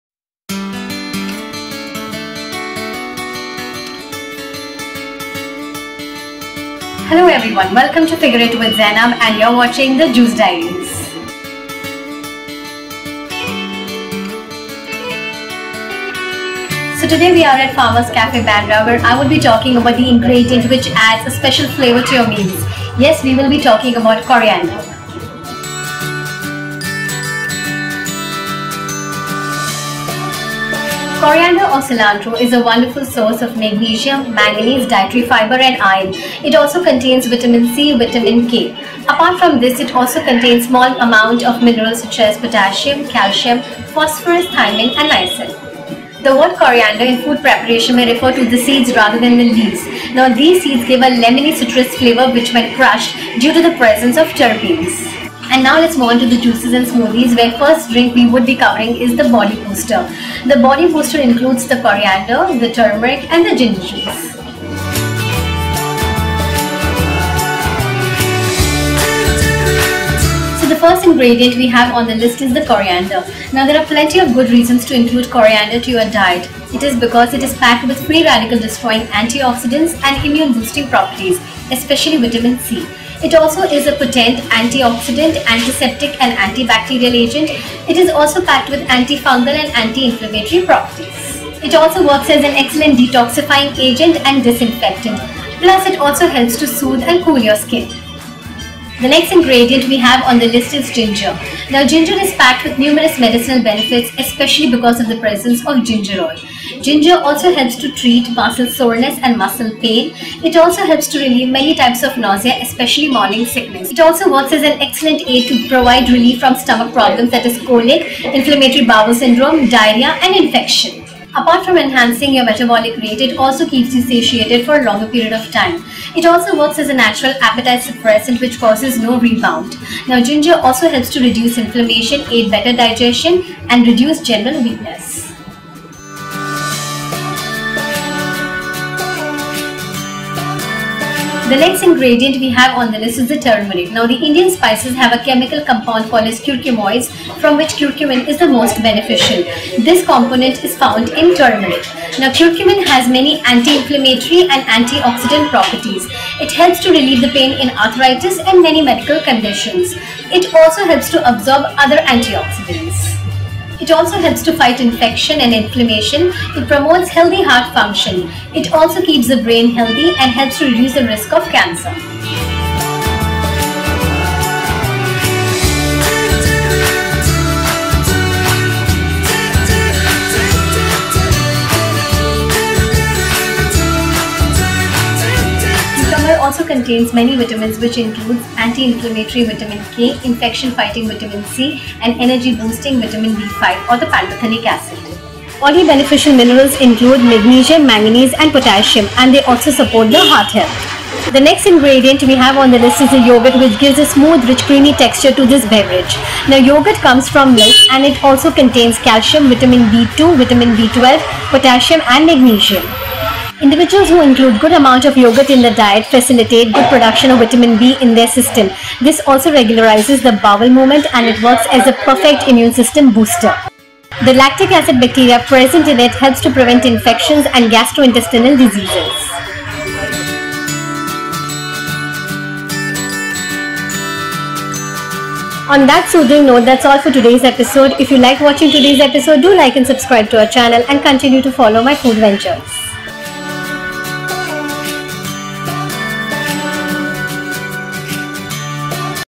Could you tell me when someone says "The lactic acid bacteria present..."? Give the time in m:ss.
3:44.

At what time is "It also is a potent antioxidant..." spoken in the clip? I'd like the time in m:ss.
1:23.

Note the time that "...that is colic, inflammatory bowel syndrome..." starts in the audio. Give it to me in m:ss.
1:57.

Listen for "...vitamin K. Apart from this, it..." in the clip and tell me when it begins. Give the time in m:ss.
0:37.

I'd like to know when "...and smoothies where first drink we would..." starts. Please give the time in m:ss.
0:56.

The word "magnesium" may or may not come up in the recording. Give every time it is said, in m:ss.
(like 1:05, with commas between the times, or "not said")
0:33, 3:17, 3:32.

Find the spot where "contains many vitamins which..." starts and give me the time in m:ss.
3:06.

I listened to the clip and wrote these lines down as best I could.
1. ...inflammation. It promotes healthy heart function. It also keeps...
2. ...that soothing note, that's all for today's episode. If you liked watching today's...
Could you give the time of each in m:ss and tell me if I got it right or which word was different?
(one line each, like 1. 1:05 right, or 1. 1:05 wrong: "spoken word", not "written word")
1. 2:45 right
2. 3:55 right.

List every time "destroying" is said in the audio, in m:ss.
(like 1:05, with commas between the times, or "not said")
1:18.